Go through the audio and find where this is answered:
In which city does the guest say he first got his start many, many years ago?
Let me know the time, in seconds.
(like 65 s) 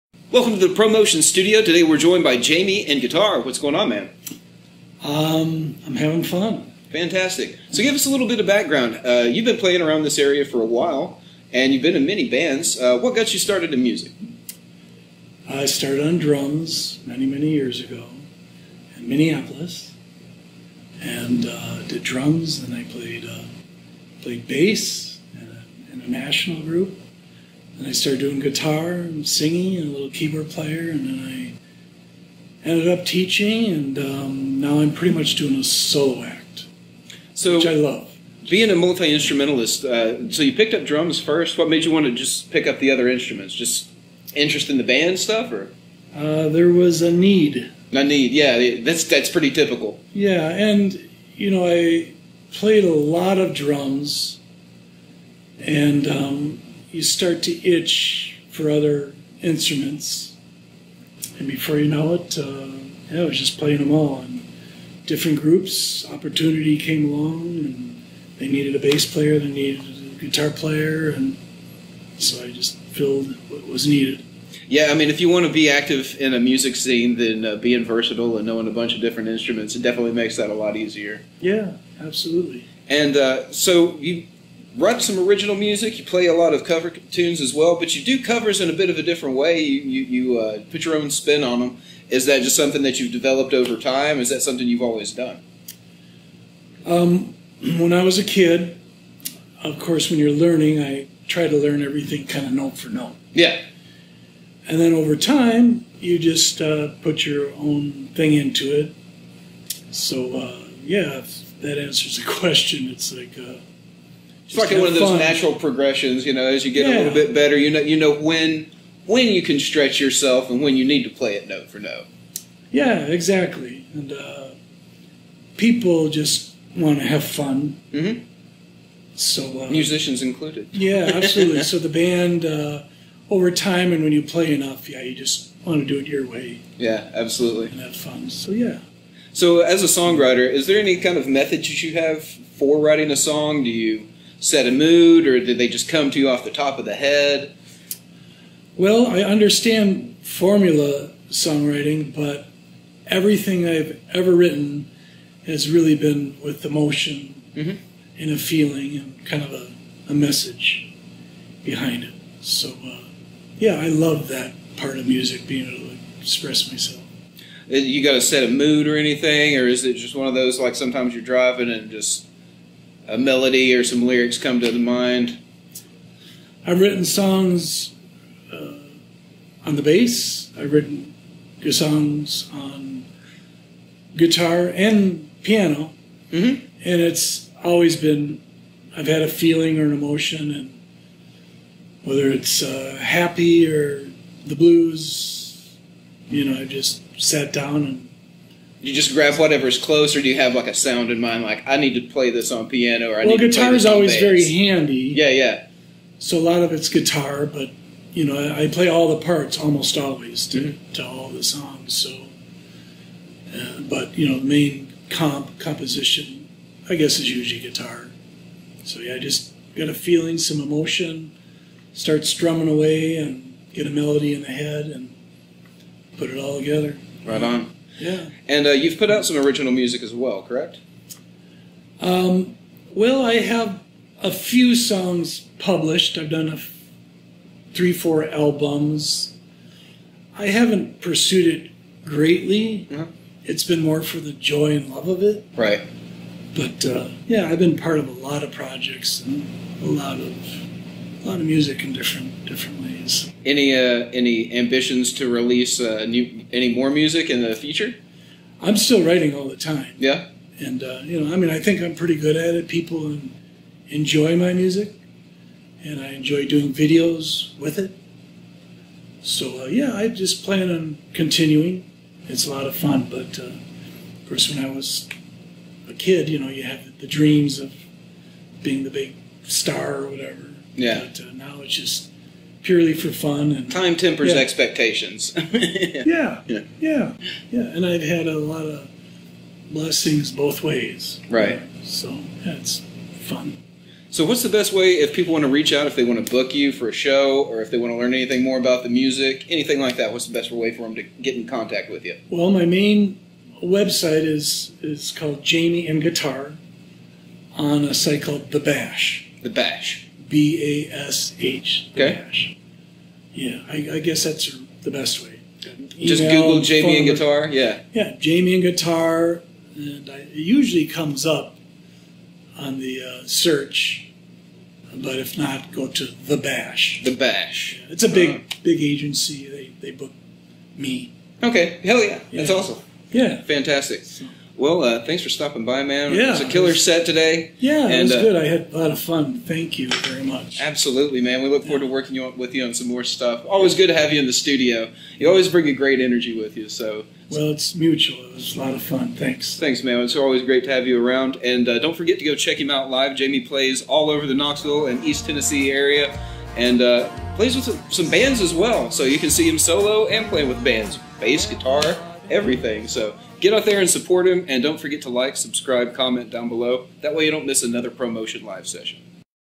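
19 s.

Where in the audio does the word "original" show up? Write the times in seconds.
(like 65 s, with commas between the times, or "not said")
85 s, 229 s.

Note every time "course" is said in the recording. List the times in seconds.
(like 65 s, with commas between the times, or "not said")
99 s, 274 s.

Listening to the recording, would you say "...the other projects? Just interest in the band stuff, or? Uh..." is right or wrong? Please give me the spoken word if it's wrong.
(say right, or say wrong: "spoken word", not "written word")
wrong: "instruments", not "projects".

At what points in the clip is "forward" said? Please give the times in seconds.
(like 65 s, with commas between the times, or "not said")
341 s.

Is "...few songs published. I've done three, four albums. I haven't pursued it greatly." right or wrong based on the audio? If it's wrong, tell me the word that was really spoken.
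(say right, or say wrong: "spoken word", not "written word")
right.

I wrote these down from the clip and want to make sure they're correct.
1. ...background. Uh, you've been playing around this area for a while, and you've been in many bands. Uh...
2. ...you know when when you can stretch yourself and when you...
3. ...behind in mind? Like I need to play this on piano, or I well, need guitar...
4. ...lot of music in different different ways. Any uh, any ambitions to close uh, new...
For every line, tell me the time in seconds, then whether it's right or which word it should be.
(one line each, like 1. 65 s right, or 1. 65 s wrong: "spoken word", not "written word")
1. 8 s right
2. 117 s right
3. 200 s wrong: "sound", not "behind"
4. 251 s wrong: "release", not "close".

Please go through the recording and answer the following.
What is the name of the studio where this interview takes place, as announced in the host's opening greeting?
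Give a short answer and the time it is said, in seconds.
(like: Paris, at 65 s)
Promotion Studio, at 0 s.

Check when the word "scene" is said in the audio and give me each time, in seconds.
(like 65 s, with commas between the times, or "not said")
76 s.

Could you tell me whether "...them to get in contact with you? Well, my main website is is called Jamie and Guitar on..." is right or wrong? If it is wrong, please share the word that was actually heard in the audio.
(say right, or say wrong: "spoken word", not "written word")
right.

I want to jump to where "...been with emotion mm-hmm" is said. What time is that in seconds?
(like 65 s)
155 s.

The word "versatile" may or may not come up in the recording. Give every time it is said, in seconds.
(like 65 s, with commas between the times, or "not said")
77 s.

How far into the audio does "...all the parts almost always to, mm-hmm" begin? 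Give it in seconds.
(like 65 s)
208 s.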